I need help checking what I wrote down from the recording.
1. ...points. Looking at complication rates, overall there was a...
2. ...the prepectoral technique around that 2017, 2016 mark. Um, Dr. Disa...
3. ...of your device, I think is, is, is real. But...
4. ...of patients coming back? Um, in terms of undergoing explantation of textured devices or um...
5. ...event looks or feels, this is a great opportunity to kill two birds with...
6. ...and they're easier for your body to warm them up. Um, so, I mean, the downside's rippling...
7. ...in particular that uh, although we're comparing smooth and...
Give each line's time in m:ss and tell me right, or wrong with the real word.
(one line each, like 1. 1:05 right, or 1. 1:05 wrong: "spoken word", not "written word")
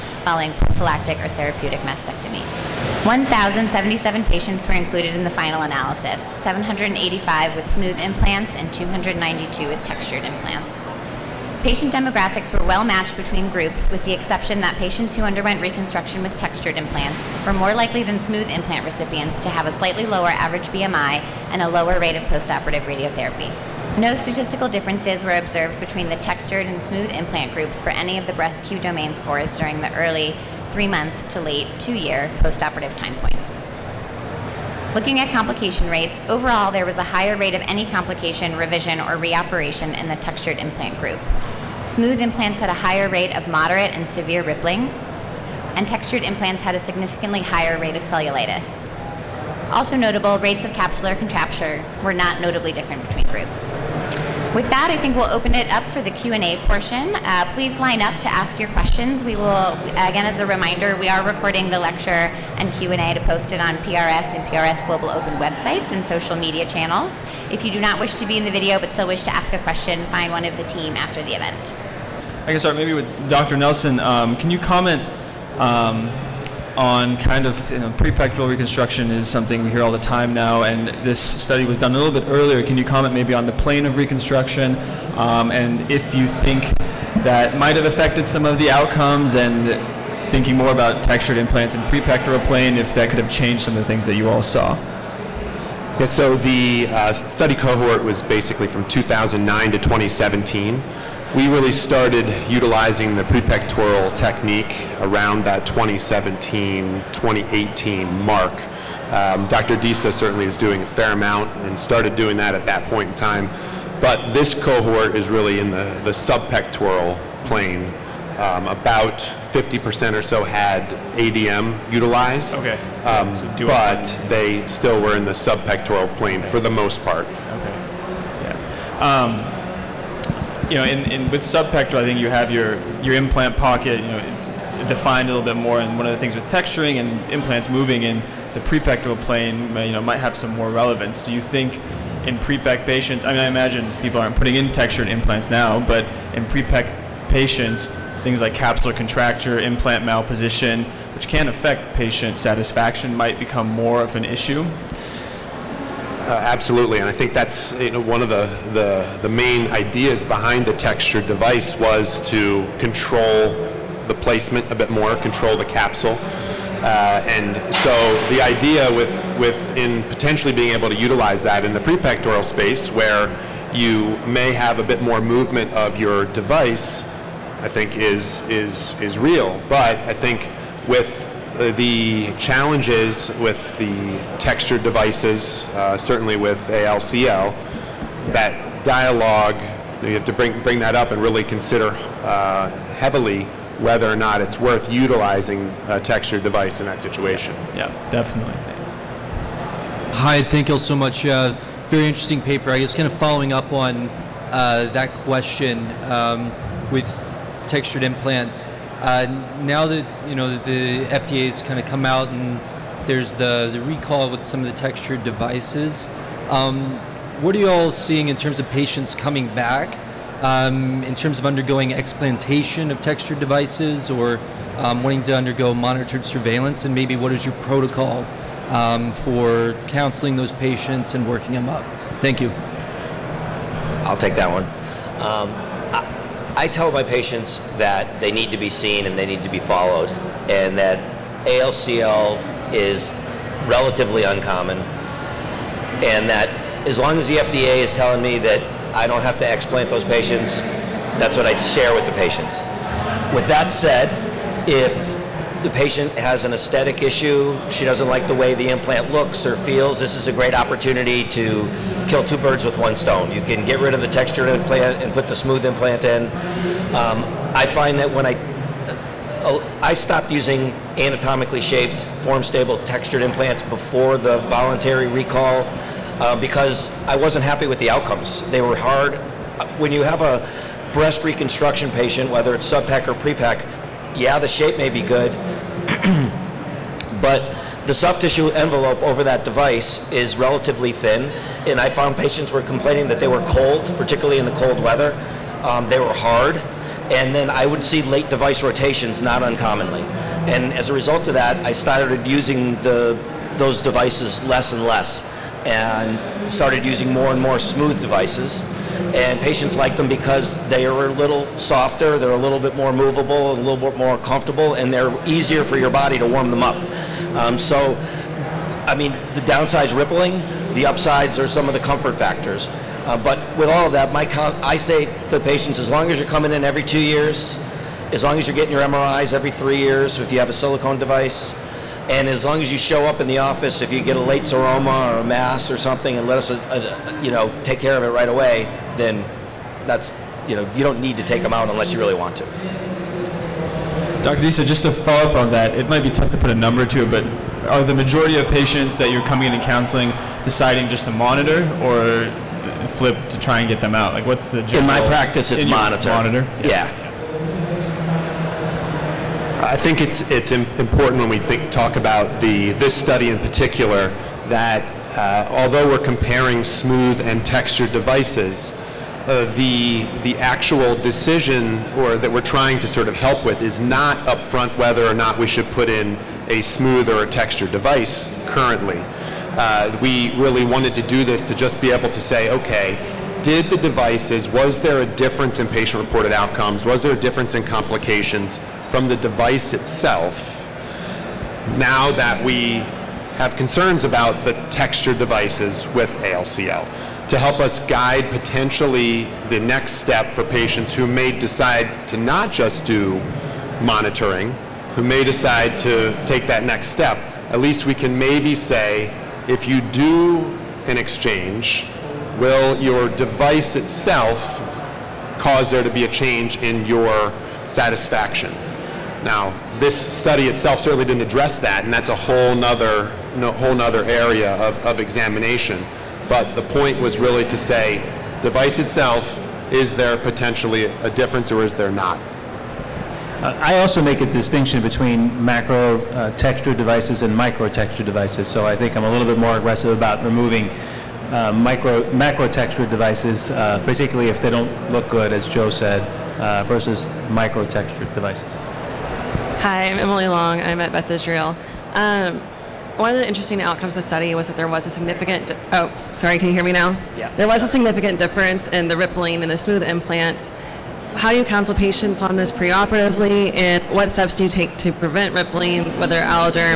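1. 0:33 right
2. 1:43 wrong: "2018", not "2016"
3. 2:55 right
4. 3:38 right
5. 4:18 wrong: "implant", not "event"
6. 5:14 right
7. 6:03 right.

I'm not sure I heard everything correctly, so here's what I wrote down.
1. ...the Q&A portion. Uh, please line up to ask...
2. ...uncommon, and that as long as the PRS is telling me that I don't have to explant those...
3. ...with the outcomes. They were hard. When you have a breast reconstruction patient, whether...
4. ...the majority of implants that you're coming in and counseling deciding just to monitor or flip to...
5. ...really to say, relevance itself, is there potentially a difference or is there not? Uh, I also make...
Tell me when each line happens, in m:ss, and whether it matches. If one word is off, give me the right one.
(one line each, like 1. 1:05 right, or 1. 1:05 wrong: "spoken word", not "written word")
1. 0:56 right
2. 4:04 wrong: "FDA", not "PRS"
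3. 4:37 right
4. 5:47 wrong: "patients", not "implants"
5. 7:07 wrong: "device", not "relevance".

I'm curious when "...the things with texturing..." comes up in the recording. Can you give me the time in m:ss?
2:16.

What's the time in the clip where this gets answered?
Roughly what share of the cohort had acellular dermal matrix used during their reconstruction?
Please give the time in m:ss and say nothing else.
1:59.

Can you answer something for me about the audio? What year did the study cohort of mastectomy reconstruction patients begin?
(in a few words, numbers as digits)
2009.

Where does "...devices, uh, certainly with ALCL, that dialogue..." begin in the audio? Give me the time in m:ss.
3:04.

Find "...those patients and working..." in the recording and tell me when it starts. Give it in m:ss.
3:50.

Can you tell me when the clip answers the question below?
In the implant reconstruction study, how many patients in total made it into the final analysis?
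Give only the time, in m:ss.
0:03.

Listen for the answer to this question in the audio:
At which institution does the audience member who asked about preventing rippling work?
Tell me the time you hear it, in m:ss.
7:30.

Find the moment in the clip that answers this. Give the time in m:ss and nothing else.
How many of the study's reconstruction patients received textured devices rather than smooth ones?
0:08.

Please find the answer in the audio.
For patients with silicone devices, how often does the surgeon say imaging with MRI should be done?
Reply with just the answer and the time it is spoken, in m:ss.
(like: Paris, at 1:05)
Every three years, at 5:29.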